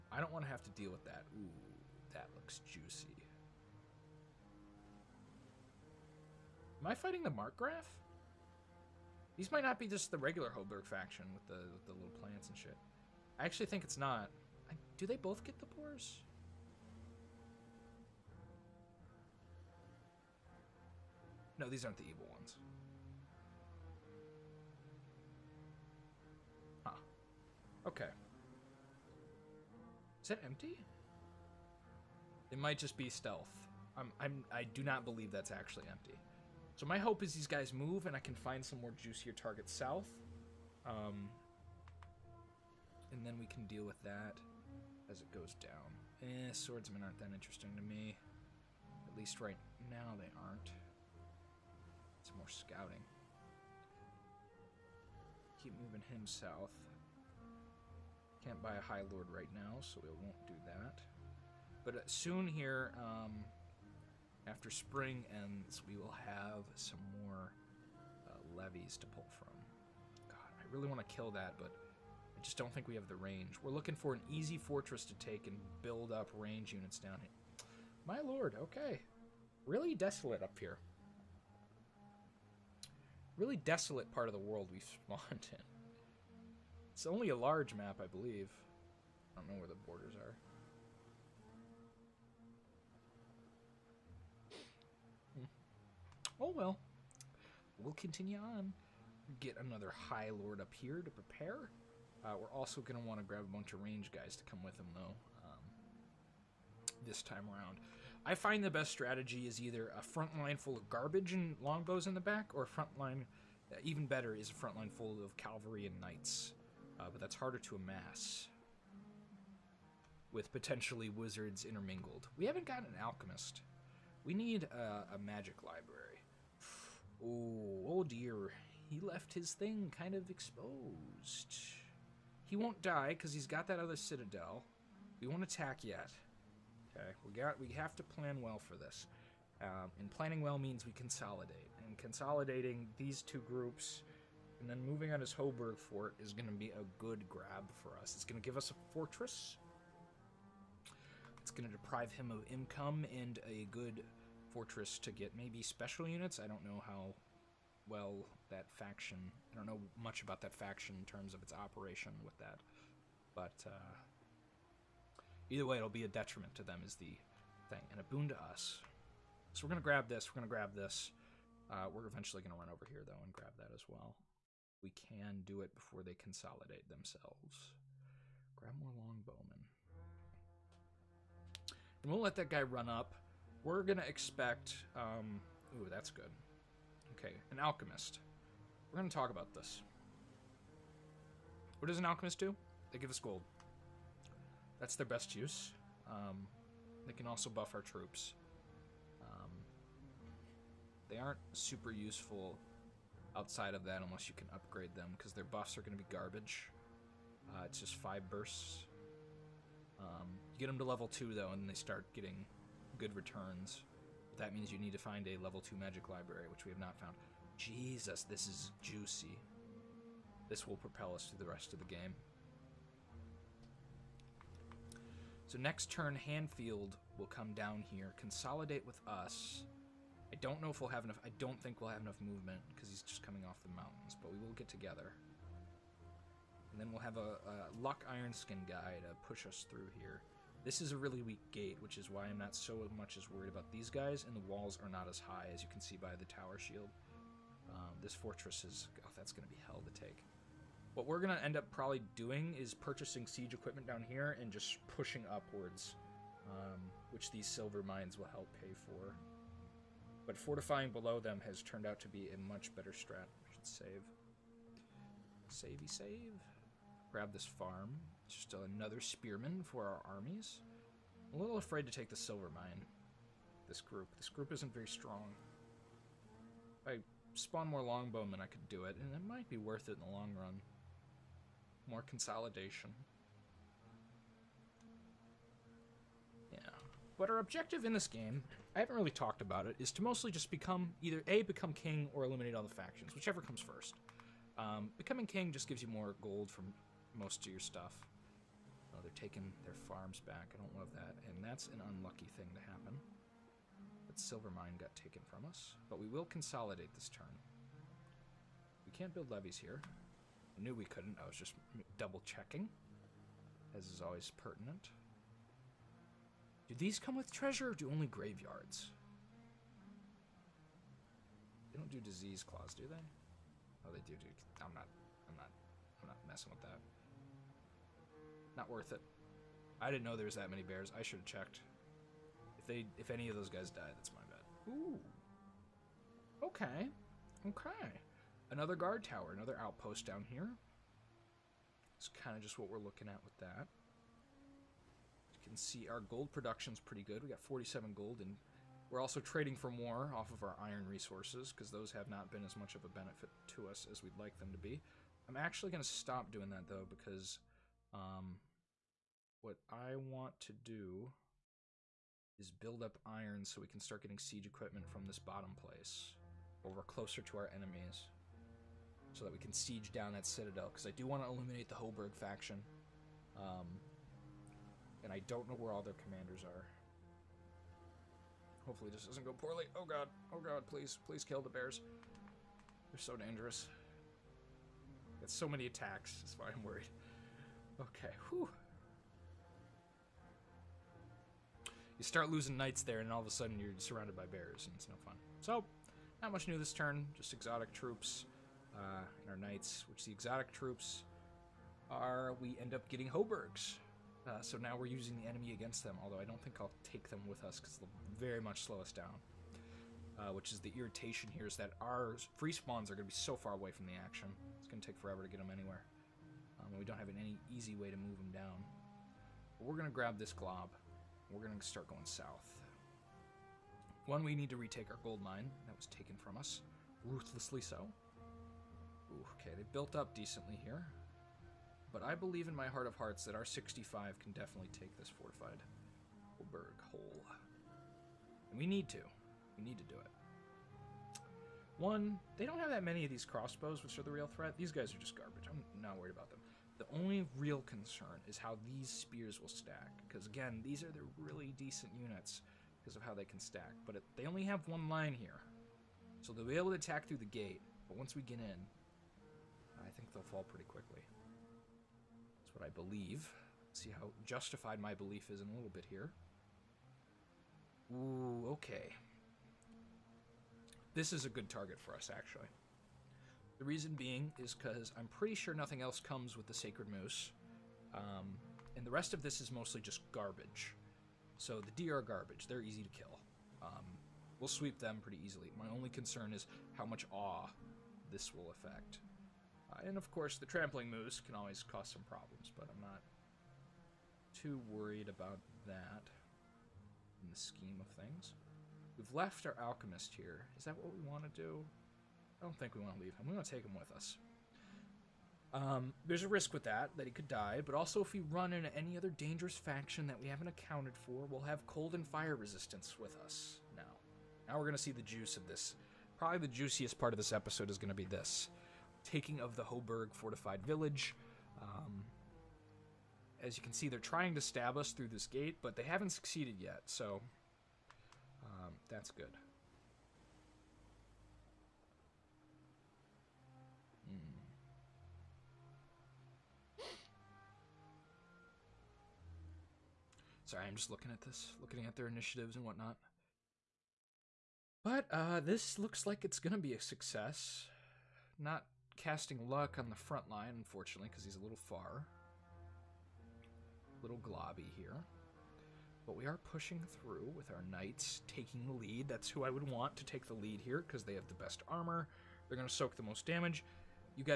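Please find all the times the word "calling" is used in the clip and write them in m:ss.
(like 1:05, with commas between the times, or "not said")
not said.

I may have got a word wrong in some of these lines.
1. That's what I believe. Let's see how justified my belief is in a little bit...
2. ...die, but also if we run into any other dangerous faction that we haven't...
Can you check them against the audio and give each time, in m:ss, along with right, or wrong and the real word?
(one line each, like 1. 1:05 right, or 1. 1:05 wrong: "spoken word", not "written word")
1. 7:42 right
2. 8:27 right.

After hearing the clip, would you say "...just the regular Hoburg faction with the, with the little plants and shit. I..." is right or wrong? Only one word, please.
right.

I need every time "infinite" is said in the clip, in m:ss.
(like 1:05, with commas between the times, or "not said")
not said.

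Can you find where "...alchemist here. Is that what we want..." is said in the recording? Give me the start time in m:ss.
8:19.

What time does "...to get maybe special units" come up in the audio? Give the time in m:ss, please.
2:34.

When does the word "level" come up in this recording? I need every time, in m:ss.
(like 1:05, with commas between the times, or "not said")
3:30, 3:35.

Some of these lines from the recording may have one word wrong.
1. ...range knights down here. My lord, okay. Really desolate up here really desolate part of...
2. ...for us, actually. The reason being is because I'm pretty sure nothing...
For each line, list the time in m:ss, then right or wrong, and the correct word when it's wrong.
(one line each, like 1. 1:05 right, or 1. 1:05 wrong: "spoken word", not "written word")
1. 1:16 wrong: "units", not "knights"
2. 7:51 right.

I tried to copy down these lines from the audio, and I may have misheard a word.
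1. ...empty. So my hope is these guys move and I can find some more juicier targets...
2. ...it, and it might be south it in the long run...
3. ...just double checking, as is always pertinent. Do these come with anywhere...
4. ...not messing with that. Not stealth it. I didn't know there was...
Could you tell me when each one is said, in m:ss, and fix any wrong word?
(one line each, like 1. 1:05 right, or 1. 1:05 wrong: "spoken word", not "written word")
1. 0:35 right
2. 4:38 wrong: "worth", not "south"
3. 5:11 wrong: "treasure", not "anywhere"
4. 5:26 wrong: "worth", not "stealth".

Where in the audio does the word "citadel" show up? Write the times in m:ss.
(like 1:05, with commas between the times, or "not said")
2:13, 6:10.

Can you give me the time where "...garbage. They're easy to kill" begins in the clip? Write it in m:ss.
8:02.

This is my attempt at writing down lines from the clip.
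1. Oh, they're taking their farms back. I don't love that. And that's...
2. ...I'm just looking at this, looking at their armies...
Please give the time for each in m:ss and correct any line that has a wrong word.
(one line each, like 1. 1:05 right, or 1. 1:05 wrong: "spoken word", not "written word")
1. 4:58 right
2. 9:00 wrong: "initiatives", not "armies".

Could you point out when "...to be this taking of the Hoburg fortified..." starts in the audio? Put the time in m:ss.
8:37.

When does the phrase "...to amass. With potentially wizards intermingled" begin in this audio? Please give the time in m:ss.
1:57.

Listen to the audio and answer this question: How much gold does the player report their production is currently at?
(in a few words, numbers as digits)
47.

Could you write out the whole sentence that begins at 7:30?
Because, again, these are the really decent units because of how they can stack.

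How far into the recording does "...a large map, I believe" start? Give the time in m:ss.
1:27.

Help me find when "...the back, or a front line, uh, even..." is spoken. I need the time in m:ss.
1:52.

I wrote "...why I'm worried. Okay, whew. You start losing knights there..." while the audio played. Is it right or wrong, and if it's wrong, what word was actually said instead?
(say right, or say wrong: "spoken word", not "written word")
right.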